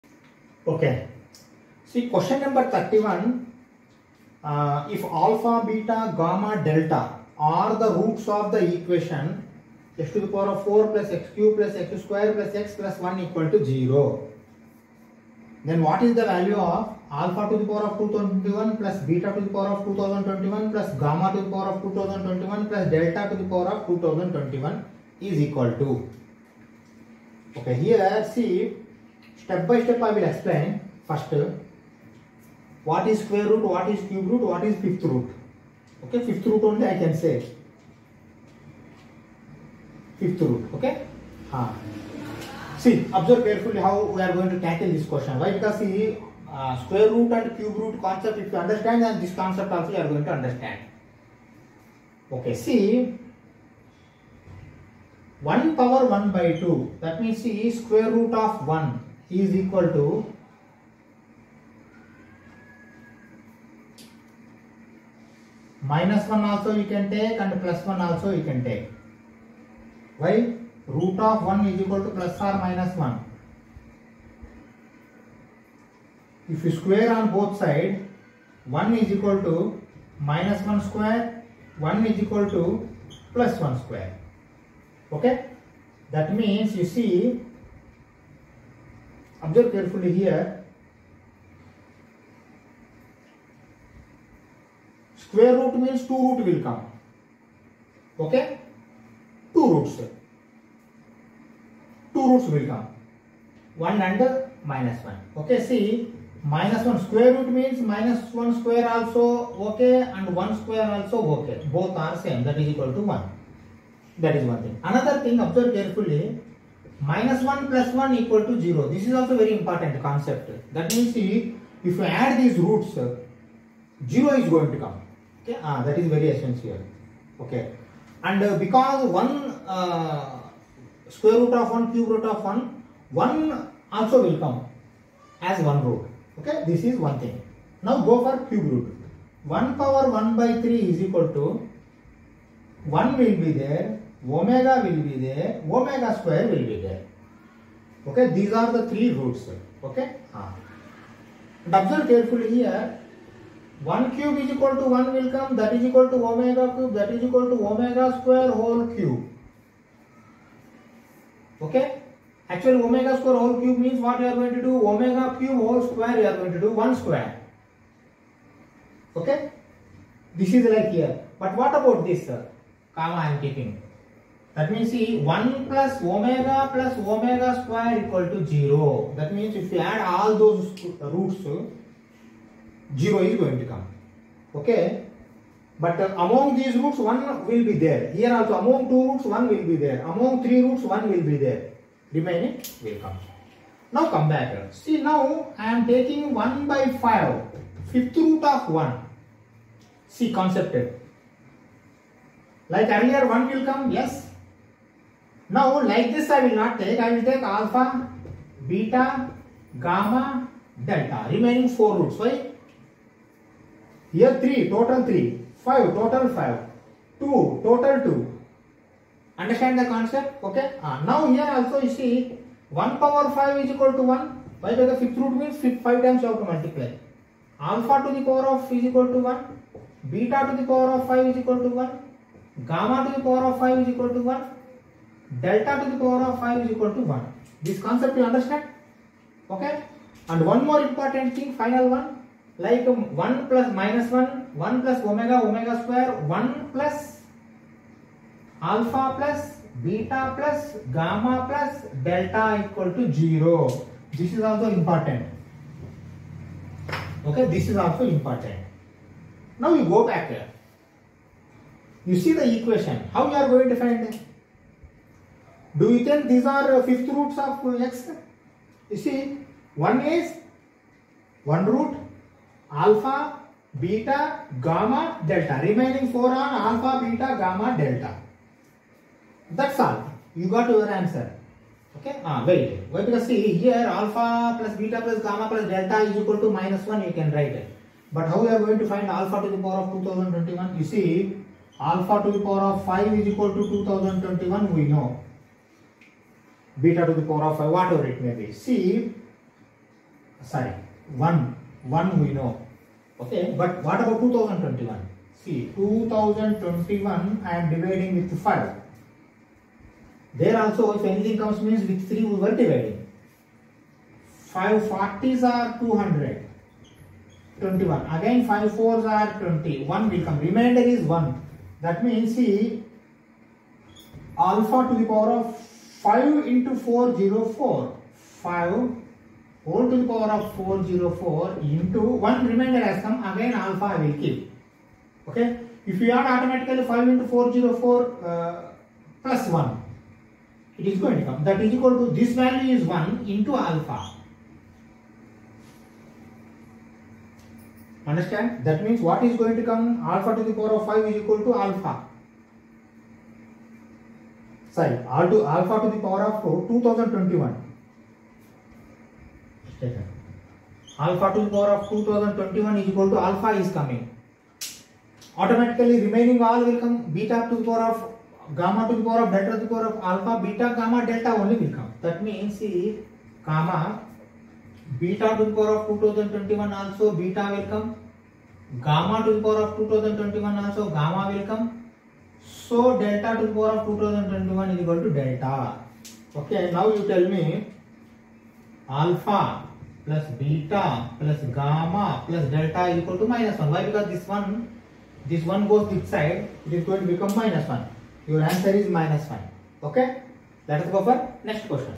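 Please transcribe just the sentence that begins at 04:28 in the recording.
You see, one is one root alpha, beta, gamma, delta.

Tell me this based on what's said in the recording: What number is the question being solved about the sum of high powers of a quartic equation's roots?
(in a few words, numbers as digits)
31.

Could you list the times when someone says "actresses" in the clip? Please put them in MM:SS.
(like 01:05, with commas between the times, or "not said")
not said.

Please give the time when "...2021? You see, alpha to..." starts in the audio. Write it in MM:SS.
04:50.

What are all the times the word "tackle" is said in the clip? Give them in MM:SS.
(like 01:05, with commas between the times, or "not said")
00:44.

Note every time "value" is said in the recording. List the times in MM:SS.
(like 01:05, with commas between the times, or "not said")
00:16, 05:42.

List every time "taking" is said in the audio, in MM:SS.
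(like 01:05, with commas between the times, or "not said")
03:15.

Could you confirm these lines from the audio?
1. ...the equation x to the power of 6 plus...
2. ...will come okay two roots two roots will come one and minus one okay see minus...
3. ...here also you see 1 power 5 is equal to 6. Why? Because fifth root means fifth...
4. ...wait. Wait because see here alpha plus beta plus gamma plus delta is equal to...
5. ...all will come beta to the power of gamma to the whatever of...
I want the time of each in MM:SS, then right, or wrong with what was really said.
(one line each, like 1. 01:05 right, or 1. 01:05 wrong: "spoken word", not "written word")
1. 00:08 wrong: "4", not "6"
2. 01:36 right
3. 03:41 wrong: "1", not "6"
4. 04:42 right
5. 06:06 wrong: "power", not "whatever".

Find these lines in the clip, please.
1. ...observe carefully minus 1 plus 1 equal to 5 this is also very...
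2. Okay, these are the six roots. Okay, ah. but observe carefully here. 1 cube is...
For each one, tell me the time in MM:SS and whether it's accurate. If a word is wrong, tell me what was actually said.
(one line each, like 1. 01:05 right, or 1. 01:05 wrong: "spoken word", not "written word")
1. 01:55 wrong: "0", not "5"
2. 02:28 wrong: "three", not "six".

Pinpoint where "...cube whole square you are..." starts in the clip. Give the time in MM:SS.
02:45.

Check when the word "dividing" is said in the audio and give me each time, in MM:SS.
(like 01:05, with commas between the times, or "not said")
05:07, 05:12.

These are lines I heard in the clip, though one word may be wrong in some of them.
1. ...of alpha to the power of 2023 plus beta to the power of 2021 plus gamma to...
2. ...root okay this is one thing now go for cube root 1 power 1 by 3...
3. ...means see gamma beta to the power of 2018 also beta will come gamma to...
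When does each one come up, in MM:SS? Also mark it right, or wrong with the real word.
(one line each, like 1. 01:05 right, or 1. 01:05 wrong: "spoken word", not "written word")
1. 00:16 wrong: "2021", not "2023"
2. 02:15 right
3. 06:12 wrong: "2021", not "2018".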